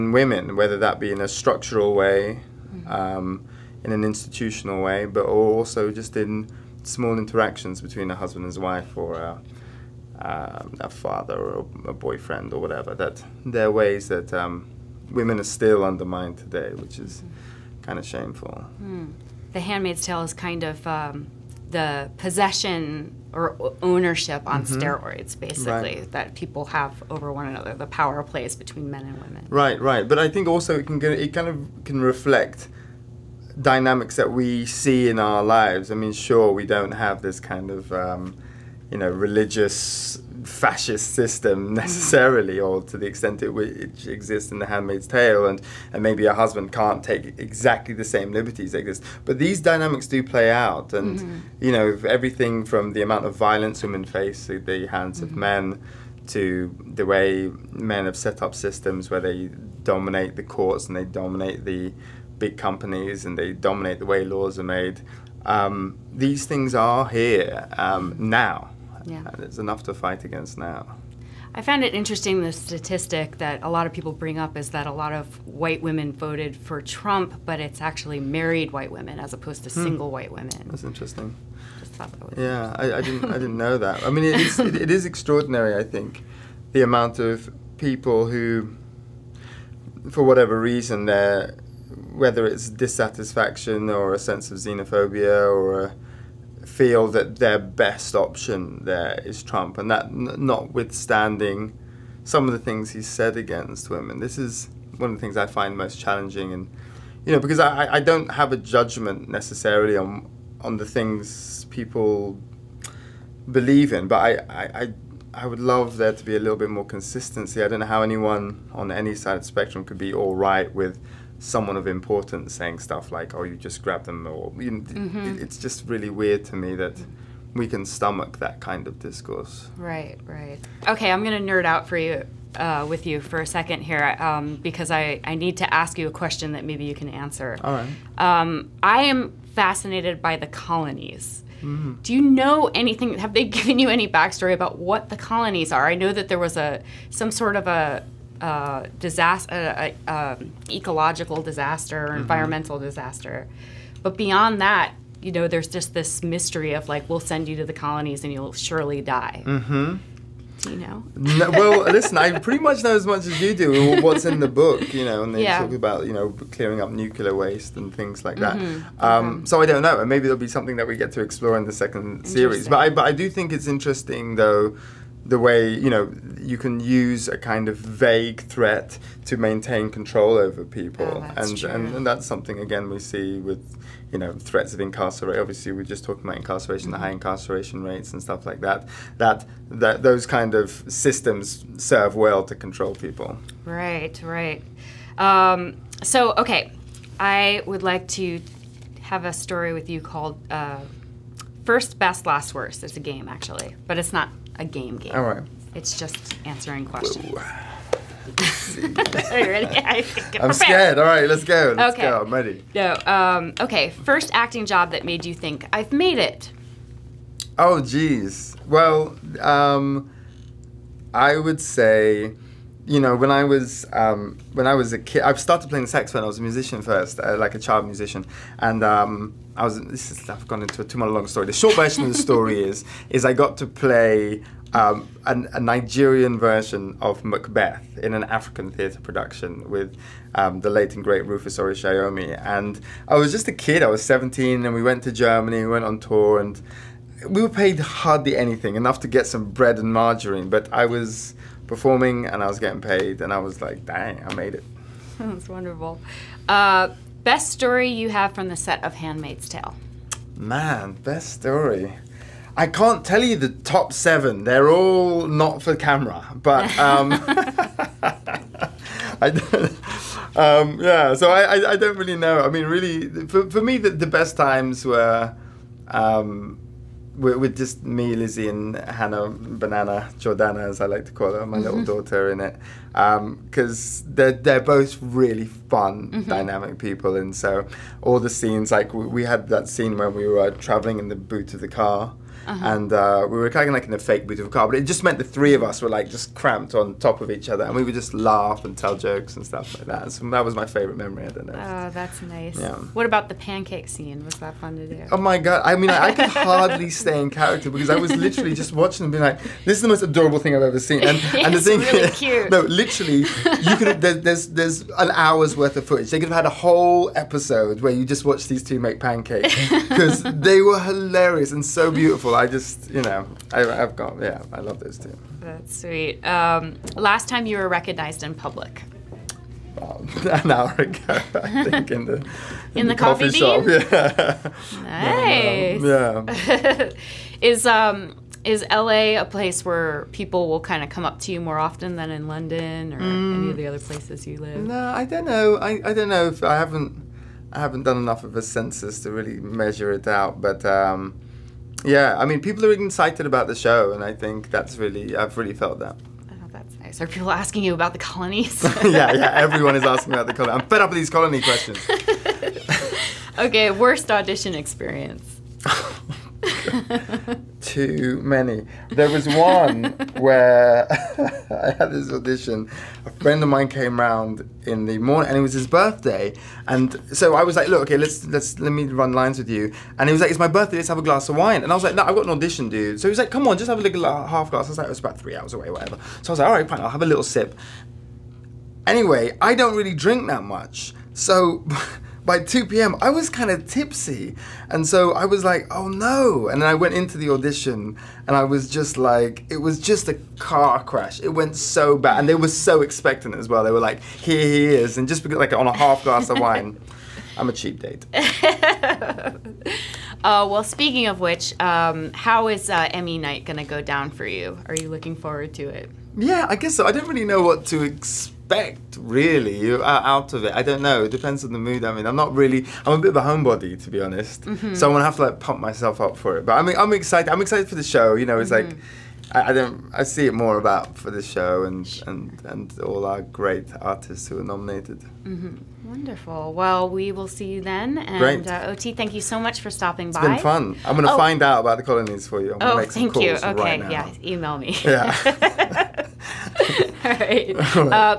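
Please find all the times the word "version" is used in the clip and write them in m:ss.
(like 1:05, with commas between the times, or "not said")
3:51, 3:56.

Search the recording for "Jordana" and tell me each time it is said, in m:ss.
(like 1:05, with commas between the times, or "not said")
4:40.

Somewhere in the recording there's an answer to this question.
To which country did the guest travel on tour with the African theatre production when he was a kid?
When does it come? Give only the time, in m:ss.
4:05.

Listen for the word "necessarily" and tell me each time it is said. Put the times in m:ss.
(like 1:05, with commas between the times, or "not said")
0:41, 1:49.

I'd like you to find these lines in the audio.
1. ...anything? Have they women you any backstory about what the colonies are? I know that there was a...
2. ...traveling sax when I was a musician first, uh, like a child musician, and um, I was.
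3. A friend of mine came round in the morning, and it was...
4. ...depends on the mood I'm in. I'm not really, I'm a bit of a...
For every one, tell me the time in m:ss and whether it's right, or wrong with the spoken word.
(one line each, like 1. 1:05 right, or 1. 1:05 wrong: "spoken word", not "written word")
1. 2:22 wrong: "given", not "women"
2. 3:45 wrong: "playing", not "traveling"
3. 6:13 right
4. 7:01 right.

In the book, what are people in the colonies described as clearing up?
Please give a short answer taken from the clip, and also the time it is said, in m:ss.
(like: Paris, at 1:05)
nuclear waste, at 2:47.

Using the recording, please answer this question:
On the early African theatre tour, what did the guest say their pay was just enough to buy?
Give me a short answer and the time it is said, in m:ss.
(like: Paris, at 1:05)
bread and margarine, at 4:09.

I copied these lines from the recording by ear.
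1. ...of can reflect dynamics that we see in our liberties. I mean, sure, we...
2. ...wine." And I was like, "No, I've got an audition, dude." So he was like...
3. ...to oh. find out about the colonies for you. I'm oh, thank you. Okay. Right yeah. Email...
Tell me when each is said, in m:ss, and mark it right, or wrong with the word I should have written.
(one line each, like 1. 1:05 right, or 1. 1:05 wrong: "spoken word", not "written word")
1. 0:31 wrong: "lives", not "liberties"
2. 6:21 right
3. 7:21 right.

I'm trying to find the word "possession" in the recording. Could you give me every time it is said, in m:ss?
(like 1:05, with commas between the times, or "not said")
0:22.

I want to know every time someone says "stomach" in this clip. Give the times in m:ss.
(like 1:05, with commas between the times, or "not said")
2:07.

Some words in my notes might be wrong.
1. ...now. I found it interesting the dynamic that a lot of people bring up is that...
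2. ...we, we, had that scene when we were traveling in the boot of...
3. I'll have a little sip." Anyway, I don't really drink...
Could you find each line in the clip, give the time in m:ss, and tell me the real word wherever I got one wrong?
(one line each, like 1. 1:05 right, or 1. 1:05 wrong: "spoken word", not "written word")
1. 1:10 wrong: "statistic", not "dynamic"
2. 4:48 right
3. 6:26 right.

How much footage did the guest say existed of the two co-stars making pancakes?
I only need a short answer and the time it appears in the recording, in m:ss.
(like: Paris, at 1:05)
an hour's worth, at 5:14.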